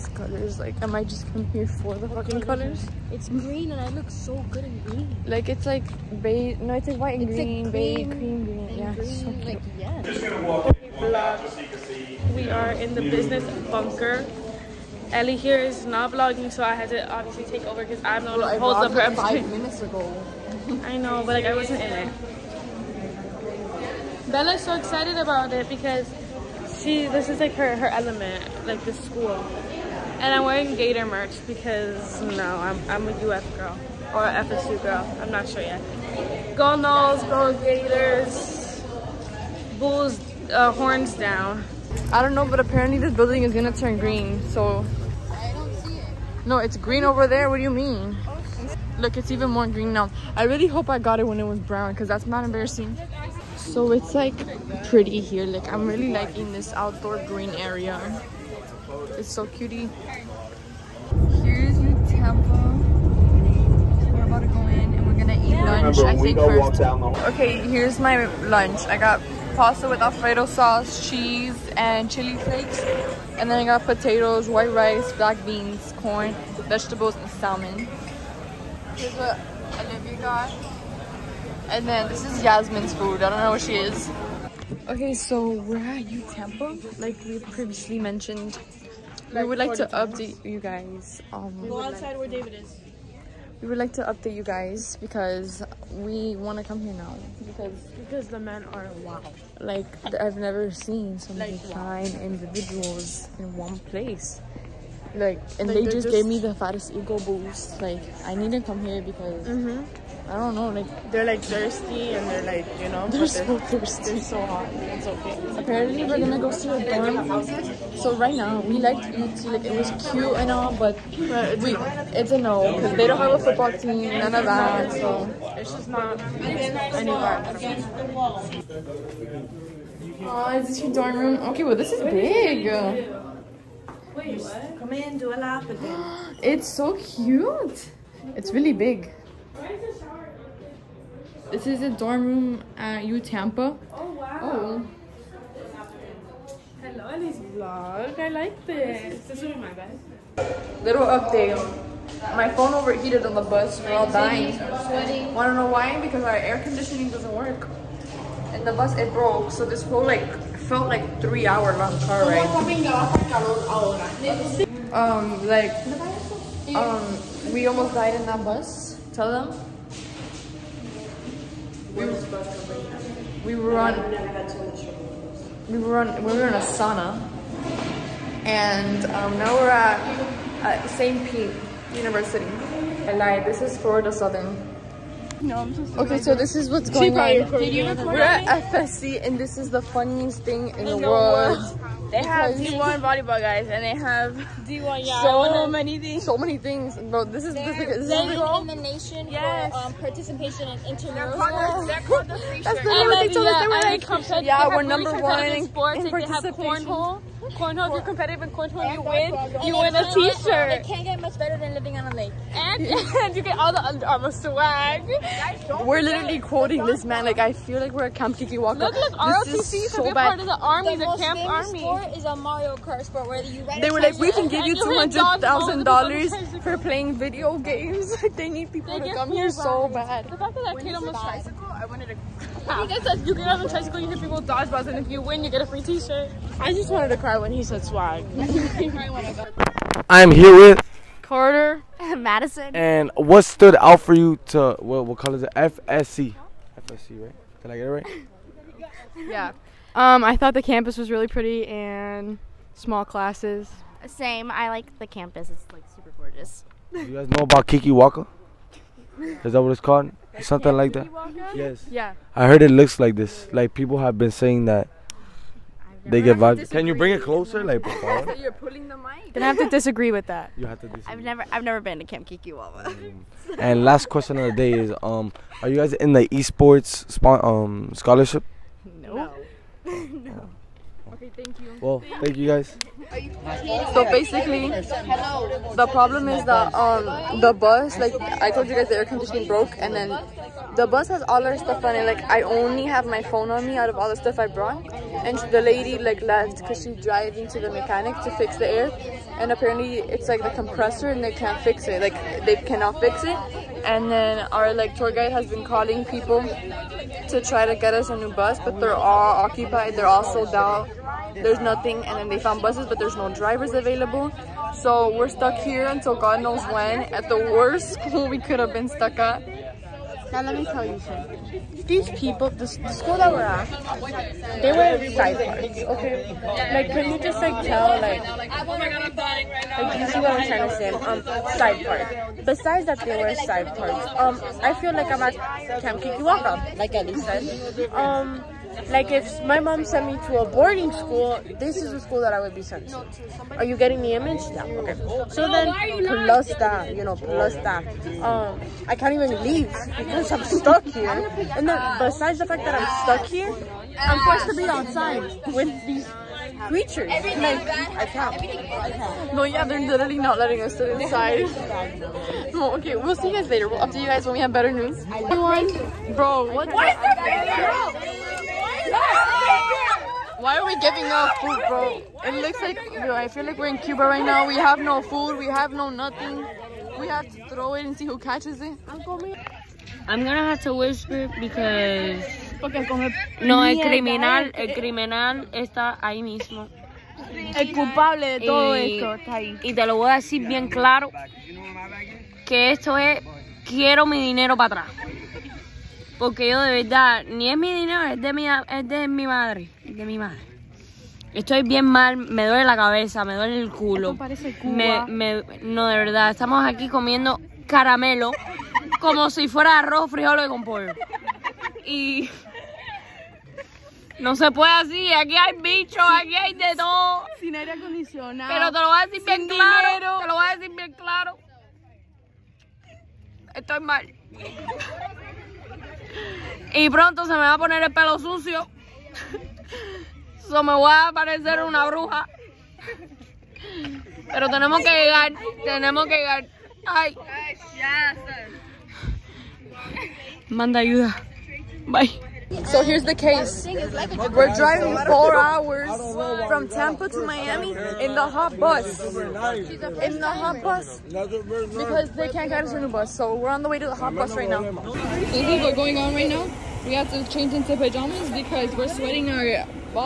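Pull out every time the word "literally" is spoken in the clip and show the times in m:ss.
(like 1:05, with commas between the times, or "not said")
3:36, 5:59.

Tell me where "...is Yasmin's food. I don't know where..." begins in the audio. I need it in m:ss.
1:22.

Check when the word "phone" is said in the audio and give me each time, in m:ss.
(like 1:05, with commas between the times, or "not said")
2:32, 4:53.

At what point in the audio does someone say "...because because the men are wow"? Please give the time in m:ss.
1:37.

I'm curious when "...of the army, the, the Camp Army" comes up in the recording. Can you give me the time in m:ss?
3:40.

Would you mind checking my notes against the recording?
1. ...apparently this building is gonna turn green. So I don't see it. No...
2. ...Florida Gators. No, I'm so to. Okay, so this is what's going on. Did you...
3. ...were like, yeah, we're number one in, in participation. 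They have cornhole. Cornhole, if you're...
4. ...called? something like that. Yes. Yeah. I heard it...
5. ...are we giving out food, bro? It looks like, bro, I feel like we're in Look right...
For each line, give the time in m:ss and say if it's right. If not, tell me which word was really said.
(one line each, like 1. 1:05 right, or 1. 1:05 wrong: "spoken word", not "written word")
1. 0:42 right
2. 3:03 wrong: "Southern", not "Gators"
3. 3:23 right
4. 4:19 right
5. 6:10 wrong: "Cuba", not "Look".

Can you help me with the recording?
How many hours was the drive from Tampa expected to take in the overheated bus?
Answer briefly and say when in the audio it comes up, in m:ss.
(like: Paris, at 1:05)
4, at 7:25.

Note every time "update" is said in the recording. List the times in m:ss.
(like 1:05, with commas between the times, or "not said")
1:29, 1:34, 2:31, 6:03.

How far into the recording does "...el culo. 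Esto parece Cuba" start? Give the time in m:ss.
6:43.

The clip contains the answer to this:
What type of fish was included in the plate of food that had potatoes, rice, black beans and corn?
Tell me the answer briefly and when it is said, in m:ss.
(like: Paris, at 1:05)
Salmon, at 1:17.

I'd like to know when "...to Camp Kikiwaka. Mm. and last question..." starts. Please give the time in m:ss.
4:31.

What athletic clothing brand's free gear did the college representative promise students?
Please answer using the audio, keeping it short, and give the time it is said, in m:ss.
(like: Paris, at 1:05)
Under Armour, at 3:33.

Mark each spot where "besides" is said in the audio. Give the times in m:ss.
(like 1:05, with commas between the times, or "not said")
5:32, 5:51.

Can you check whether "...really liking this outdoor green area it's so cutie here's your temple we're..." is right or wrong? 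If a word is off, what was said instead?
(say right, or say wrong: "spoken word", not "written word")
right.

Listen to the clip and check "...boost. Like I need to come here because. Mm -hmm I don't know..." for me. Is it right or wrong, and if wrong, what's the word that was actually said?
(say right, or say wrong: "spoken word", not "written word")
right.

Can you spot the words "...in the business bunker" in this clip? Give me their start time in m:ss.
0:12.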